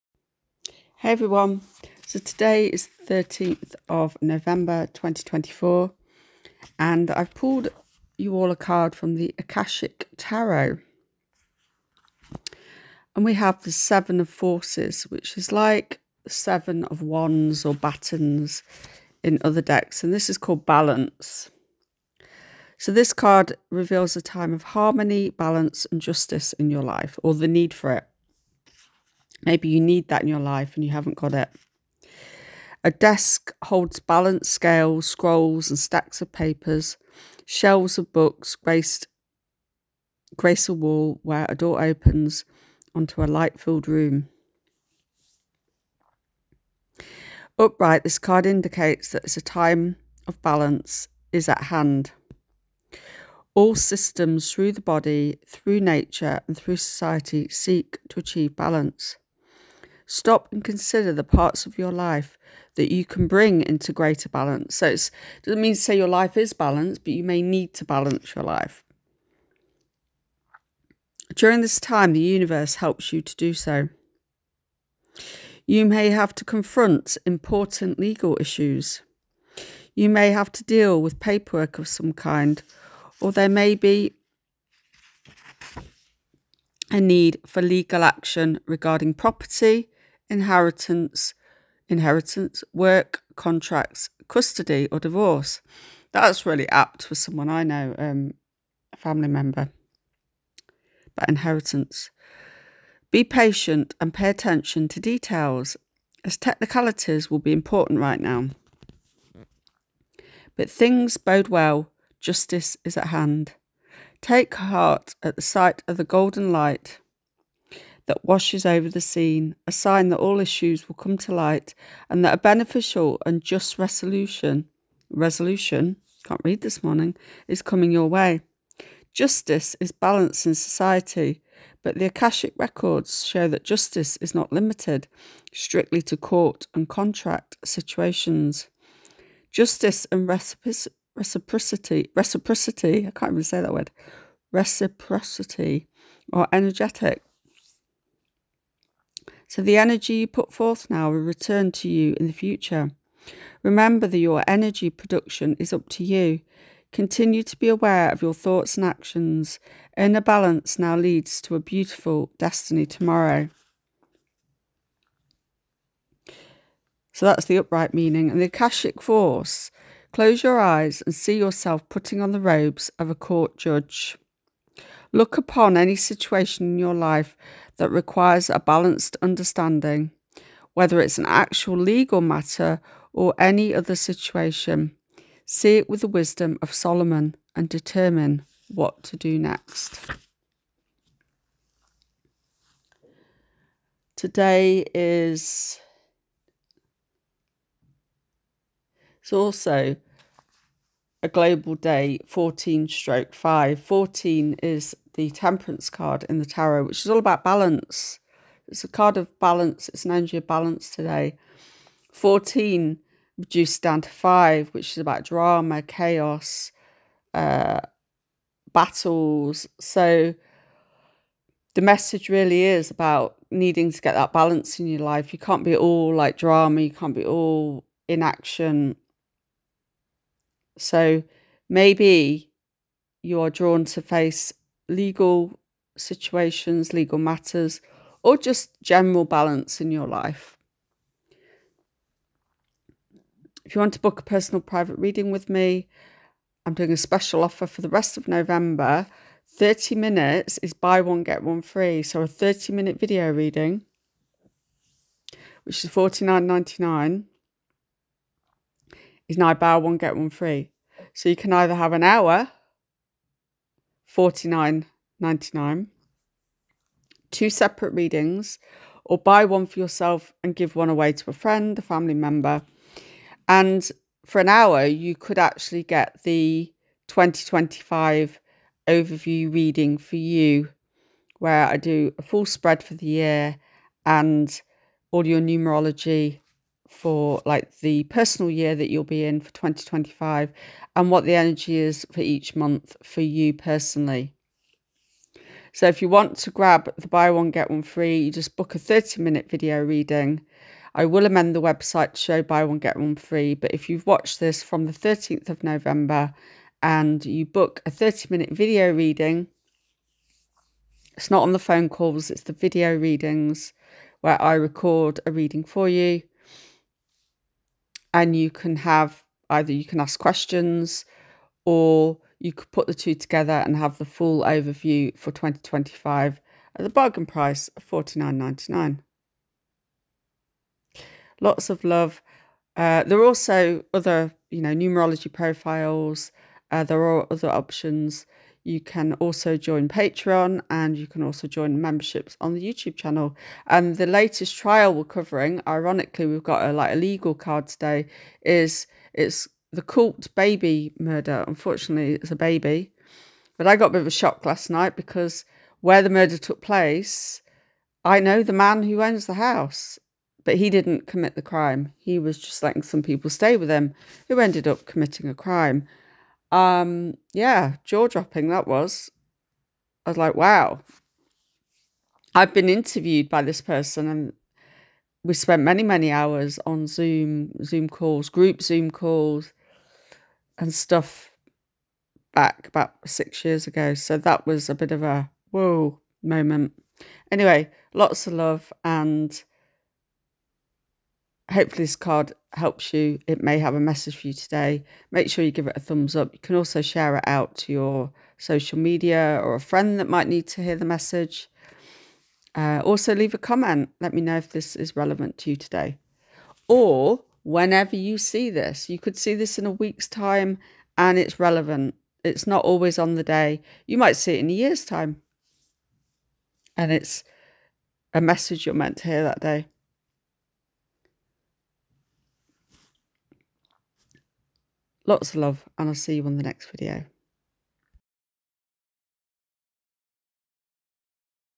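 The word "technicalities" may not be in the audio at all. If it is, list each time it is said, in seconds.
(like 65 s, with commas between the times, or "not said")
106 s.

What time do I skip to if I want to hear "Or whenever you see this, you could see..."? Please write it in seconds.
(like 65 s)
406 s.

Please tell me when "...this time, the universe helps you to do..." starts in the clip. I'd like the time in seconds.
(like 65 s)
71 s.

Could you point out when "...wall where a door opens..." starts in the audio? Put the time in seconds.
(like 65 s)
40 s.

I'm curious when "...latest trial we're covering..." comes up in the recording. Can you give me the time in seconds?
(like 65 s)
344 s.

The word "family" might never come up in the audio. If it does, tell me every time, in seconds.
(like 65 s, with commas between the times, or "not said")
98 s, 271 s.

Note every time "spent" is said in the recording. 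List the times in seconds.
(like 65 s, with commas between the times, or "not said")
375 s.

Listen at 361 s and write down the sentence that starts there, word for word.
He was just letting some people stay with him who ended up committing a crime.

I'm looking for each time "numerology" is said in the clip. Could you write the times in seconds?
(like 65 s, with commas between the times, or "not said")
285 s, 334 s.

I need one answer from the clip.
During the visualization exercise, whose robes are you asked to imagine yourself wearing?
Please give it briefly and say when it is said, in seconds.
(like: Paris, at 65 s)
A court judge, at 173 s.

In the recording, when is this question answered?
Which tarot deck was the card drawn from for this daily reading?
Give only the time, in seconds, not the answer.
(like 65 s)
9 s.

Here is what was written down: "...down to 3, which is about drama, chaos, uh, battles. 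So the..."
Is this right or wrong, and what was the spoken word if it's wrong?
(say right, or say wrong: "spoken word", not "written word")
wrong: "5", not "3".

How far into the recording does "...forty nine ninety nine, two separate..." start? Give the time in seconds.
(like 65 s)
264 s.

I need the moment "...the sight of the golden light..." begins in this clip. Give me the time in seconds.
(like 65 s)
115 s.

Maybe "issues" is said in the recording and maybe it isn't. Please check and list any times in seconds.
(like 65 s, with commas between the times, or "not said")
78 s, 120 s.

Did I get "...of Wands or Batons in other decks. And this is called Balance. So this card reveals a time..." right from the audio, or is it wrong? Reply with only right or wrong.
right.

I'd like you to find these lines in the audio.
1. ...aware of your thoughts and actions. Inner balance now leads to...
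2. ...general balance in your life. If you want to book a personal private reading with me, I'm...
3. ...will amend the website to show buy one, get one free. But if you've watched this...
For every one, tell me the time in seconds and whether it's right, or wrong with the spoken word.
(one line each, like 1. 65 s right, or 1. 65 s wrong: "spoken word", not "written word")
1. 157 s right
2. 238 s right
3. 301 s right.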